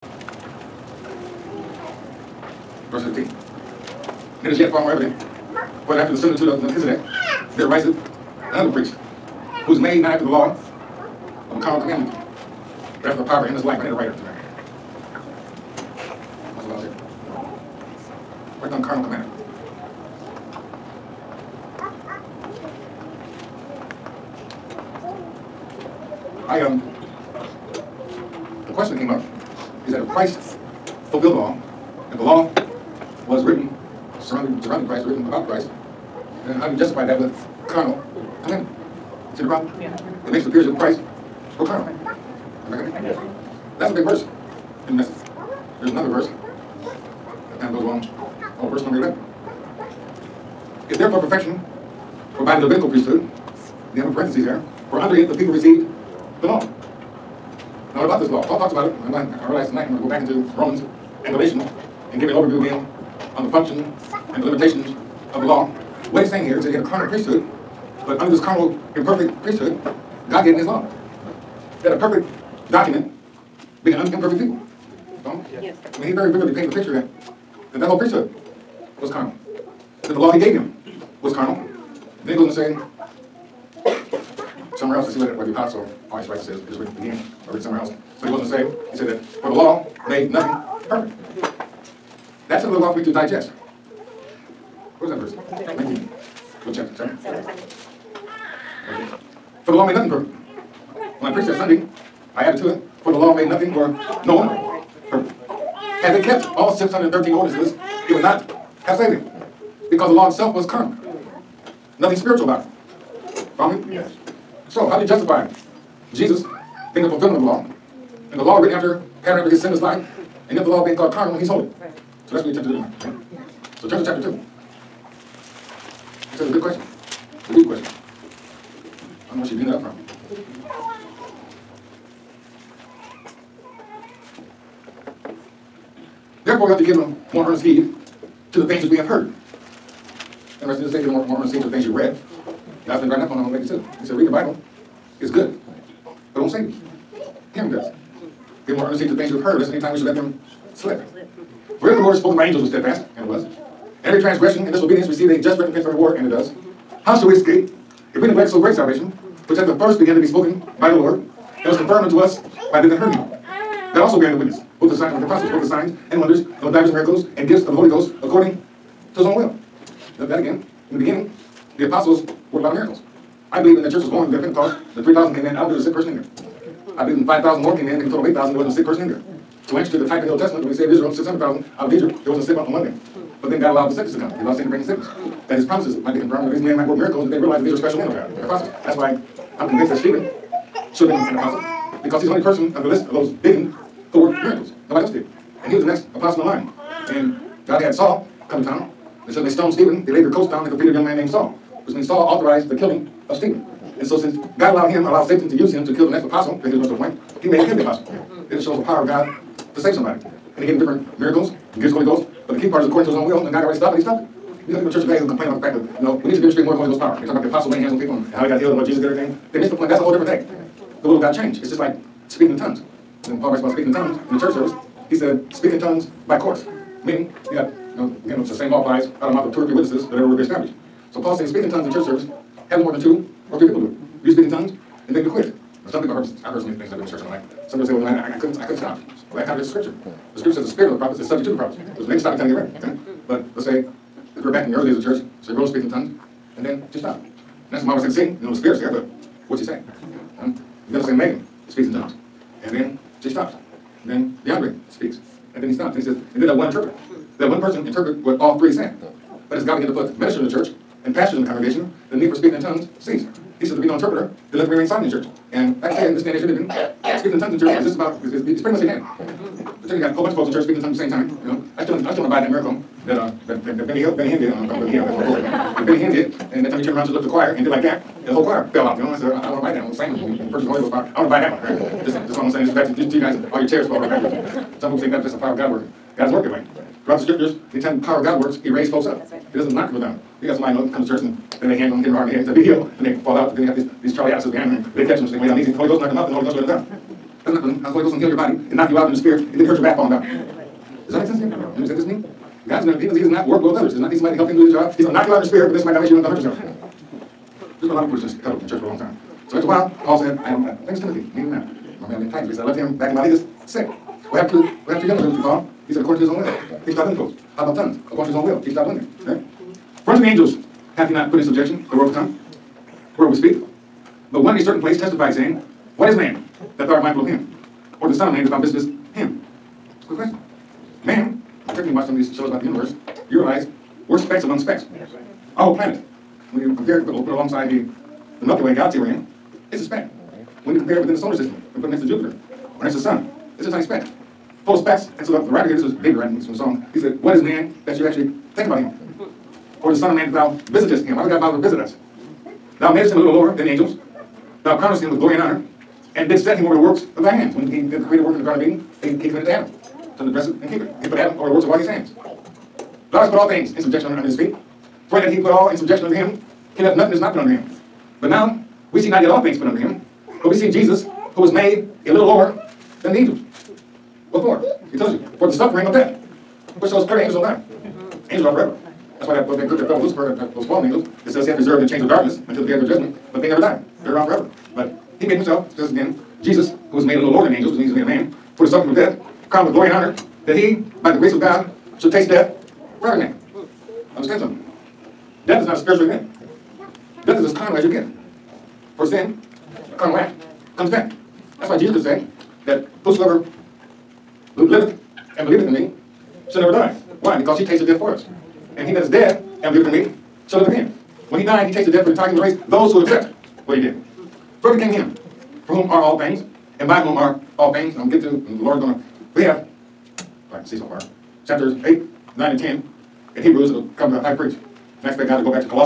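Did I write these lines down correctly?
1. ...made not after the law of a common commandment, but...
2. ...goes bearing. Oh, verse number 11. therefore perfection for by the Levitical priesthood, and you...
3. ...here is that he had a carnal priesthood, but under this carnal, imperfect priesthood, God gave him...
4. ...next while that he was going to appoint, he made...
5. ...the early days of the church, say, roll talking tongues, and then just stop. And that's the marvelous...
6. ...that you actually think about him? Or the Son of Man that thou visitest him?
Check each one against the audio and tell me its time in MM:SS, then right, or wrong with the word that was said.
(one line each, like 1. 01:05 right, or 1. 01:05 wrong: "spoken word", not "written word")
1. 00:09 right
2. 00:47 wrong: "along", not "bearing"
3. 01:06 right
4. 03:26 wrong: "apostle", not "while"
5. 04:04 wrong: "speaking", not "talking"
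6. 05:47 right.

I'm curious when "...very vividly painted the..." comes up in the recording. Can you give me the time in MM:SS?
01:16.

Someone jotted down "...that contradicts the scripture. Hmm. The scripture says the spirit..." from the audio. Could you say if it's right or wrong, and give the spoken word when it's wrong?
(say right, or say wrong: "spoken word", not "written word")
right.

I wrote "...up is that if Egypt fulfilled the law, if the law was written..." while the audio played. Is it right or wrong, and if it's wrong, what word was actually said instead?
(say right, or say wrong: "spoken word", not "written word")
wrong: "Christ", not "Egypt".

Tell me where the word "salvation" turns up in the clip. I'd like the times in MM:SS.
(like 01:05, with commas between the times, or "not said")
02:38.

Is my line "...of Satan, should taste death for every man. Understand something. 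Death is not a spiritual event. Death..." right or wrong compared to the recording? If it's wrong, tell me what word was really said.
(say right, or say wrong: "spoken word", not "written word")
wrong: "God", not "Satan".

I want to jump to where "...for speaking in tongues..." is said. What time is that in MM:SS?
04:22.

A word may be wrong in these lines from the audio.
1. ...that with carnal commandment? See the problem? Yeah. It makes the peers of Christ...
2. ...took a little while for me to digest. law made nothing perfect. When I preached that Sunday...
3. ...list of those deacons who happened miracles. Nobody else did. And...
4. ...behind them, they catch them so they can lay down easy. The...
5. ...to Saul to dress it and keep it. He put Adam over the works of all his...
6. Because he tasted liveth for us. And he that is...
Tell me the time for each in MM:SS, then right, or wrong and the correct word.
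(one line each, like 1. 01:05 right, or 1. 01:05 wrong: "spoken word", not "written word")
1. 00:37 right
2. 01:32 right
3. 03:12 wrong: "worked", not "happened"
4. 04:54 right
5. 05:59 wrong: "Adam", not "Saul"
6. 06:47 wrong: "death", not "liveth".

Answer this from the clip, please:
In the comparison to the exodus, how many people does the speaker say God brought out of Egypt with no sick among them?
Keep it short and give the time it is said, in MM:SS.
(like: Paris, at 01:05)
600,000, at 03:01.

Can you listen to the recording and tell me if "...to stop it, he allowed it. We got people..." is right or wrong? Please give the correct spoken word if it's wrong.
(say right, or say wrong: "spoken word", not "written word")
wrong: "stopped", not "allowed".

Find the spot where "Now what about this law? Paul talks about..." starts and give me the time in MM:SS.
00:57.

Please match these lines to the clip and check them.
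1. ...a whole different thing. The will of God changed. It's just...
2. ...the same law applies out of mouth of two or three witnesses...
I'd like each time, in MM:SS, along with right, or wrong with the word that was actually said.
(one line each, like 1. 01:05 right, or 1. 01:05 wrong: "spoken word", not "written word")
1. 03:39 right
2. 03:48 right.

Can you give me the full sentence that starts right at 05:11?
My man named Titus, but he said, I left him back in Miletus sick.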